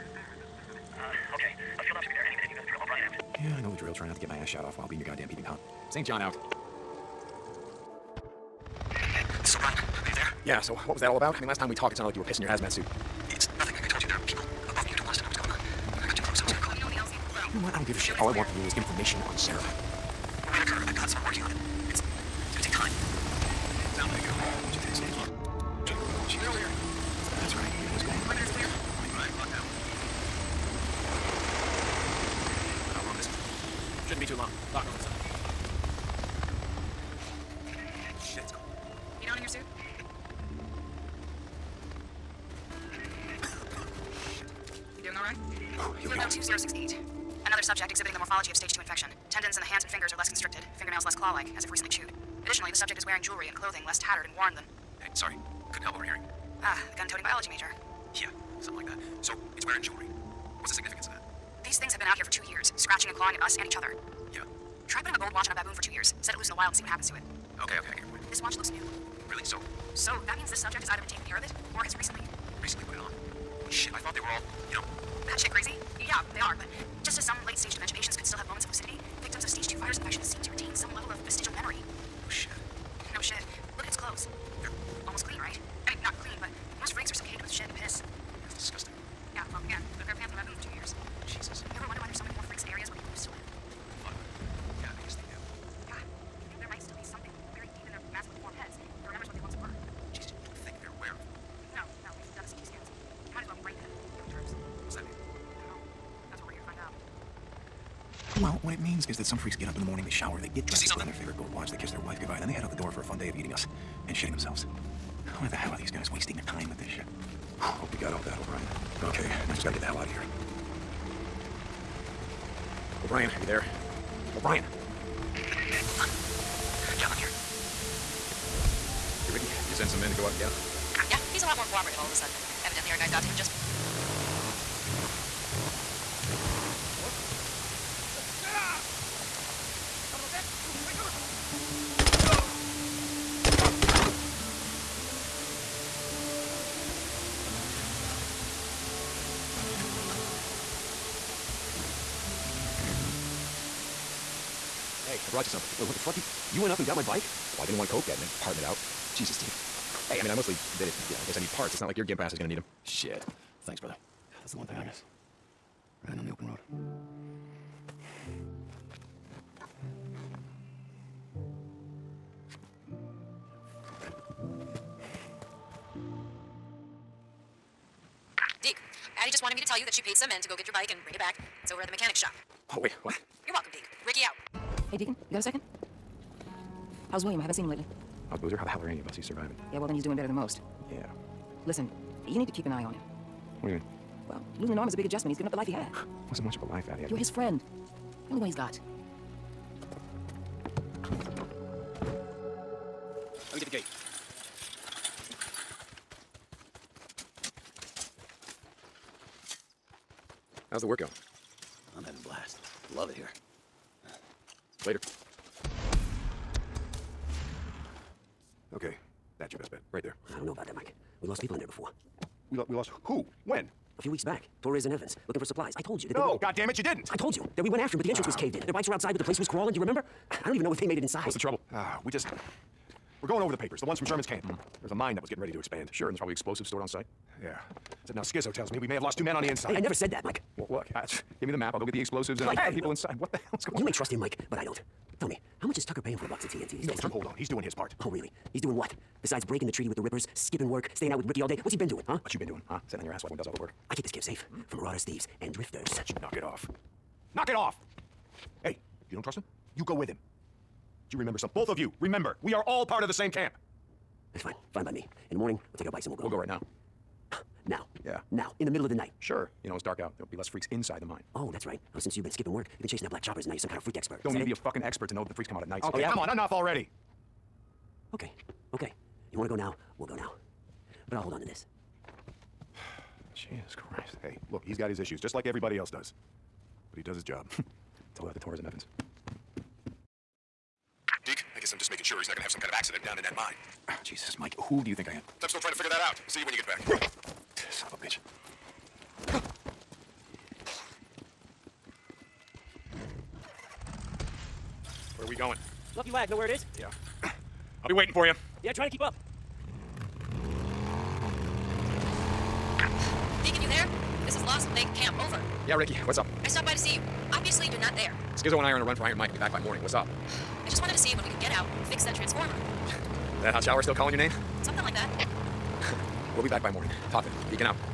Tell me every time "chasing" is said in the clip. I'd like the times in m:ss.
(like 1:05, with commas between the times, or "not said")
4:32.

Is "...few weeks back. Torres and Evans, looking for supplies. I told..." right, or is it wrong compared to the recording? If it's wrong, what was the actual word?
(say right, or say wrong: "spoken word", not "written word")
right.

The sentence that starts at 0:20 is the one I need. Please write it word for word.
Whitaker, I've got someone working on it.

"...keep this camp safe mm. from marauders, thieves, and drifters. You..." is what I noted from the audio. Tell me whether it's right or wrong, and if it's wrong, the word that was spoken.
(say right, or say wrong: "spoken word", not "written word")
right.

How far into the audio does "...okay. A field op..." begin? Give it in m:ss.
0:01.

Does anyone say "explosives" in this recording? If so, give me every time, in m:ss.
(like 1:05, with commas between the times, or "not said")
3:56, 4:01.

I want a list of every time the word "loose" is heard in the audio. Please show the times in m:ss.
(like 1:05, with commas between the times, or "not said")
1:06.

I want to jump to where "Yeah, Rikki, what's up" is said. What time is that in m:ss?
5:15.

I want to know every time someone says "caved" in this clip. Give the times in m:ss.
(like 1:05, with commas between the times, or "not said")
3:48.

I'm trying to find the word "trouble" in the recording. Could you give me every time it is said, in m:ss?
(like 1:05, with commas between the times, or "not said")
3:51.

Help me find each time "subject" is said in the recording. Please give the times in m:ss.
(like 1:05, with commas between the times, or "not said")
0:47, 0:52, 1:10.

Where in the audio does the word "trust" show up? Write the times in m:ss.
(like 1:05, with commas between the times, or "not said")
4:03, 4:19.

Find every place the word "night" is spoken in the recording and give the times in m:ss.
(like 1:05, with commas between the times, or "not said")
4:28, 4:35.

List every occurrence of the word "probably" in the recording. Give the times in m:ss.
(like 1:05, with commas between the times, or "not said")
3:56.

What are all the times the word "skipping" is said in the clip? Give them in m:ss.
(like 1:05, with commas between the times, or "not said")
4:10, 4:32.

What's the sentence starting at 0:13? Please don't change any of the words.
I, I told you, there are people above me who don't want us to know what's going on.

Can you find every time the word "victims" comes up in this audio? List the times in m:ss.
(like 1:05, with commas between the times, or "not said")
1:19.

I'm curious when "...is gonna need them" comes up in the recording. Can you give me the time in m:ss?
2:42.